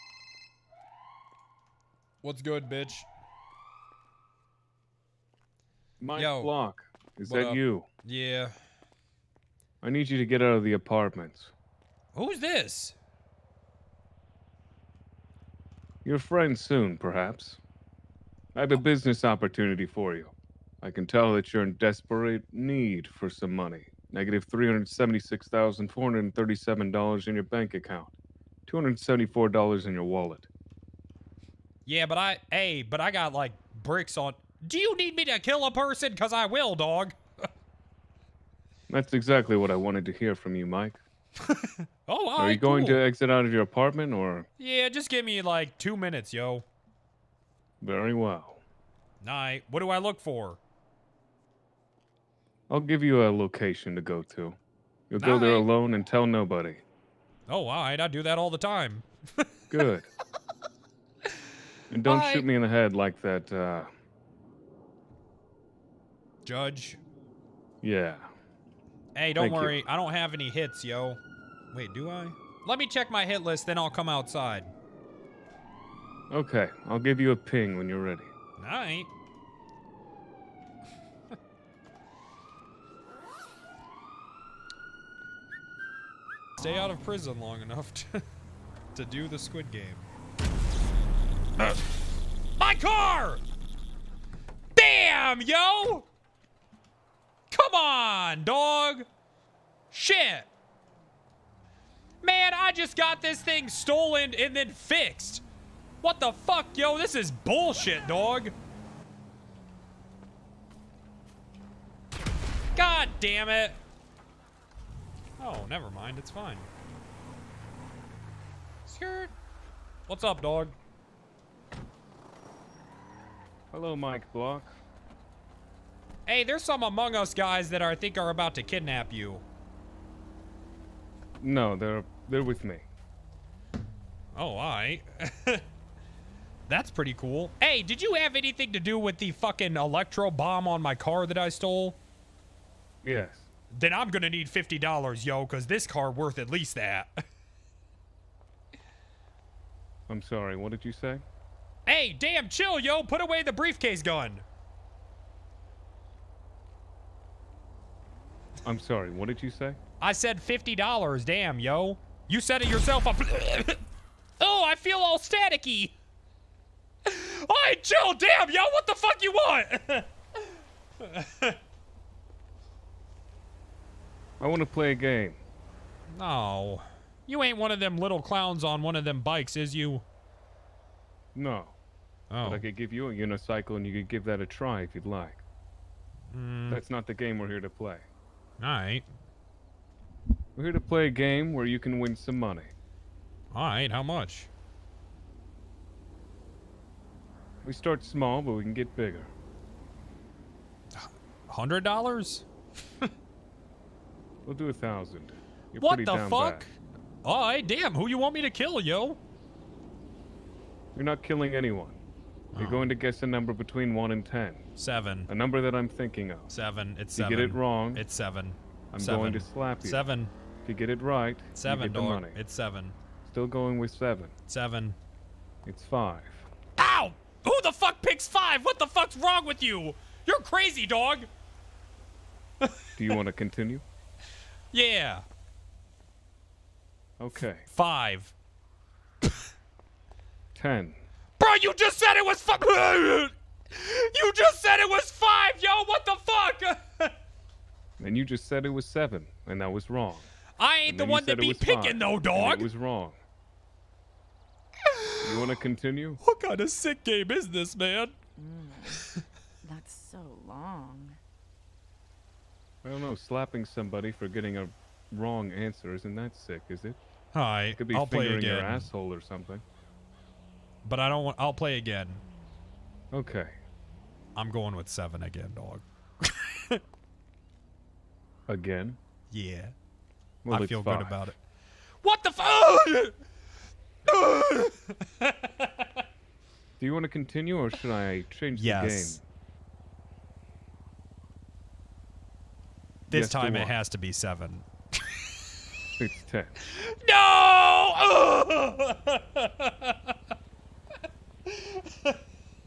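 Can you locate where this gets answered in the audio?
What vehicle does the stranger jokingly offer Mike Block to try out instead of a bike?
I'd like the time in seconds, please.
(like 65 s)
183 s.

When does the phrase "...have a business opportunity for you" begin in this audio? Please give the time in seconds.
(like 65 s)
18 s.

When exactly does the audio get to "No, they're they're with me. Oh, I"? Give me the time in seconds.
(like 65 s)
131 s.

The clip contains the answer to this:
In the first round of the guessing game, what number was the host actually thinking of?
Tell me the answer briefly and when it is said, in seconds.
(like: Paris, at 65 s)
5, at 225 s.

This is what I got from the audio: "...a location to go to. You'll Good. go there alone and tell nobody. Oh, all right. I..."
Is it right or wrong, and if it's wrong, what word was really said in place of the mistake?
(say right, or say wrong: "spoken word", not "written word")
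wrong: "Night", not "Good".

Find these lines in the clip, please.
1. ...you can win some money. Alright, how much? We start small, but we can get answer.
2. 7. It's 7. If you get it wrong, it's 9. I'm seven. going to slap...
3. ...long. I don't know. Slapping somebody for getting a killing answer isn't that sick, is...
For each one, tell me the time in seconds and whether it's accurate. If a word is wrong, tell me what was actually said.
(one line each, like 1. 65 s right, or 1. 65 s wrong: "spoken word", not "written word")
1. 191 s wrong: "bigger", not "answer"
2. 216 s wrong: "7", not "9"
3. 260 s wrong: "wrong", not "killing".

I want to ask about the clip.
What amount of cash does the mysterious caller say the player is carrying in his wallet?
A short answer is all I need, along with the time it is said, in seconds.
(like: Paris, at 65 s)
$274, at 28 s.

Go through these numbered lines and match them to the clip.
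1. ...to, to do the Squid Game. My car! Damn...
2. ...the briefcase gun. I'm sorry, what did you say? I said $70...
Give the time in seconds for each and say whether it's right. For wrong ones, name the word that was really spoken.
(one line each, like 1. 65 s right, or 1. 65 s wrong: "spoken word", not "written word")
1. 87 s right
2. 153 s wrong: "50", not "70".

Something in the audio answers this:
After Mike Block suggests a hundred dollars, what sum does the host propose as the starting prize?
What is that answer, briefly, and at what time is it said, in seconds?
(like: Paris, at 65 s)
1,000, at 204 s.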